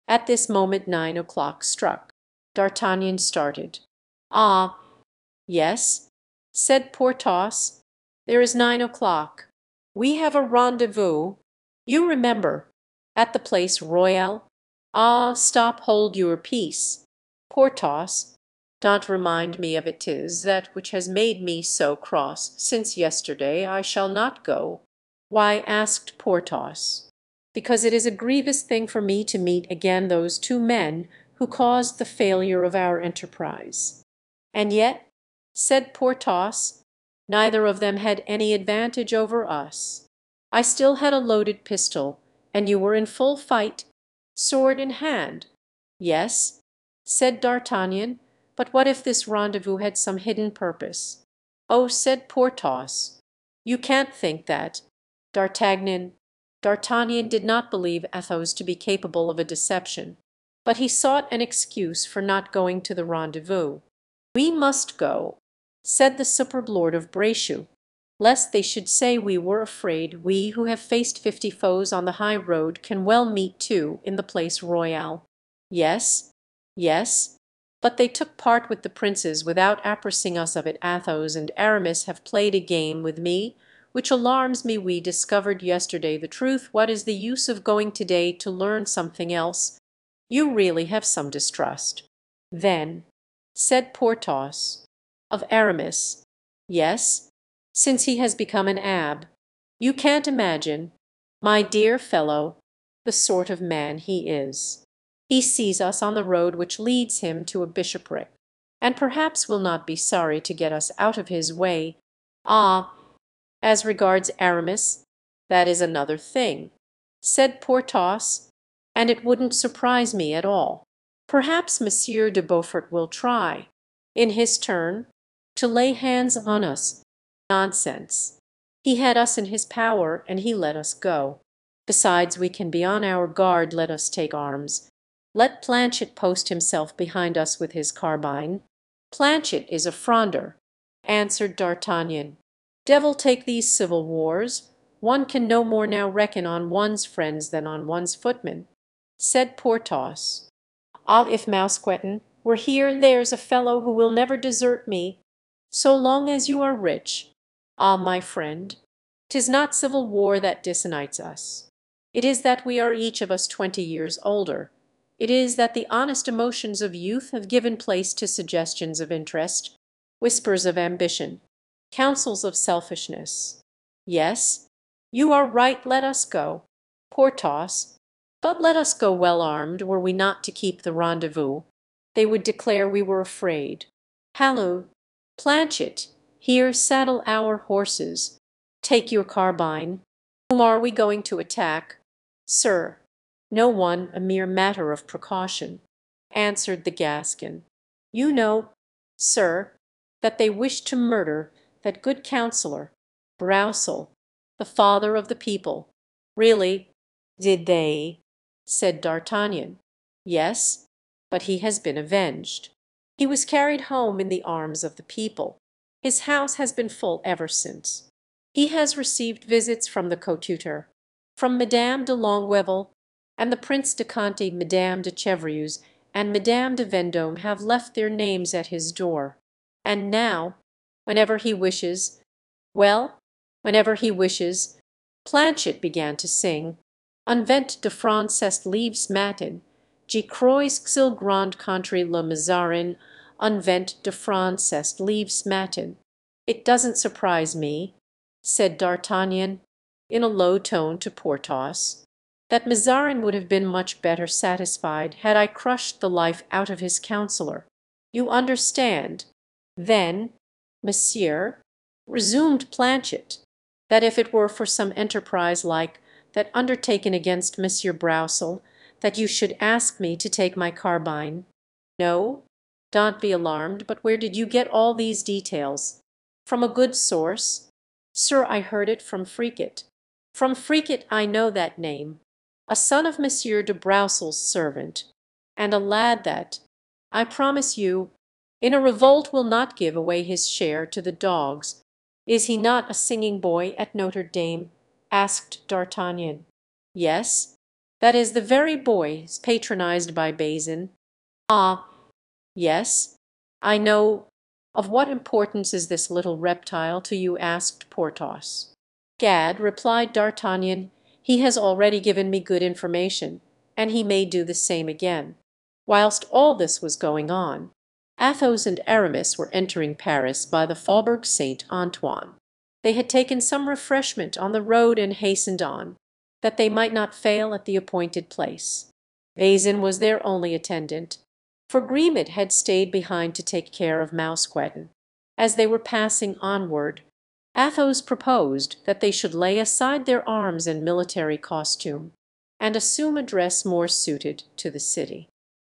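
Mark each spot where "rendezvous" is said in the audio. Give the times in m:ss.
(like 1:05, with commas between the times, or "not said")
0:10, 0:49, 1:03, 3:00.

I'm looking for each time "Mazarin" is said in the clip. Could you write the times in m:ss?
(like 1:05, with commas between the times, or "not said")
4:02, 4:12.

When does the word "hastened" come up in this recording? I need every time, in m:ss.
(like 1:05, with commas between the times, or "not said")
5:25.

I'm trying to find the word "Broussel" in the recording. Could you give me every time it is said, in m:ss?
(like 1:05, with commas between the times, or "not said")
3:23, 4:27, 4:43.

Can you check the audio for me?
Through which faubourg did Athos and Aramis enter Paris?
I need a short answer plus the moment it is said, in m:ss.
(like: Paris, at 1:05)
Faubourg Saint Antoine, at 5:20.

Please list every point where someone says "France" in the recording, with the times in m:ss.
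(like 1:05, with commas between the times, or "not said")
3:57, 4:04.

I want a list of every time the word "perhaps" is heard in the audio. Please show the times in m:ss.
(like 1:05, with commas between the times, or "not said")
1:48, 2:01.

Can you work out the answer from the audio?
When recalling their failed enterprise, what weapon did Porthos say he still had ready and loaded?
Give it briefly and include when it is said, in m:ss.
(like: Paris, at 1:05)
pistol, at 0:41.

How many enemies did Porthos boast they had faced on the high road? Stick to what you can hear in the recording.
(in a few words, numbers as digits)
50.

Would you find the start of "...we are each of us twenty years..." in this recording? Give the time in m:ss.
2:42.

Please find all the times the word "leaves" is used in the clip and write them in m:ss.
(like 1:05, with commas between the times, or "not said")
3:58, 4:04.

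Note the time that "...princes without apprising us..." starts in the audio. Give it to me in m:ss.
1:18.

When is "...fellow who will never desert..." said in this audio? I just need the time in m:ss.
2:33.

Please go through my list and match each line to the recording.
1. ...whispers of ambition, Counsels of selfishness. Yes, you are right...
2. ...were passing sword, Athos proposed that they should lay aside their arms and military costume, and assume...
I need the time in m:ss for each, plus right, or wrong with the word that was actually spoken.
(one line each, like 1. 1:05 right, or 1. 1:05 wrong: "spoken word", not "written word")
1. 2:50 right
2. 5:35 wrong: "onward", not "sword".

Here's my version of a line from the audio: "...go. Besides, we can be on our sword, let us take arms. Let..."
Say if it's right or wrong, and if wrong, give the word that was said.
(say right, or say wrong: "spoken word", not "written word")
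wrong: "guard", not "sword".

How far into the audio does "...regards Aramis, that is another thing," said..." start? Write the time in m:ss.
1:53.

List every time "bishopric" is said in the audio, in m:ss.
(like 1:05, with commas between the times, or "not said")
1:47.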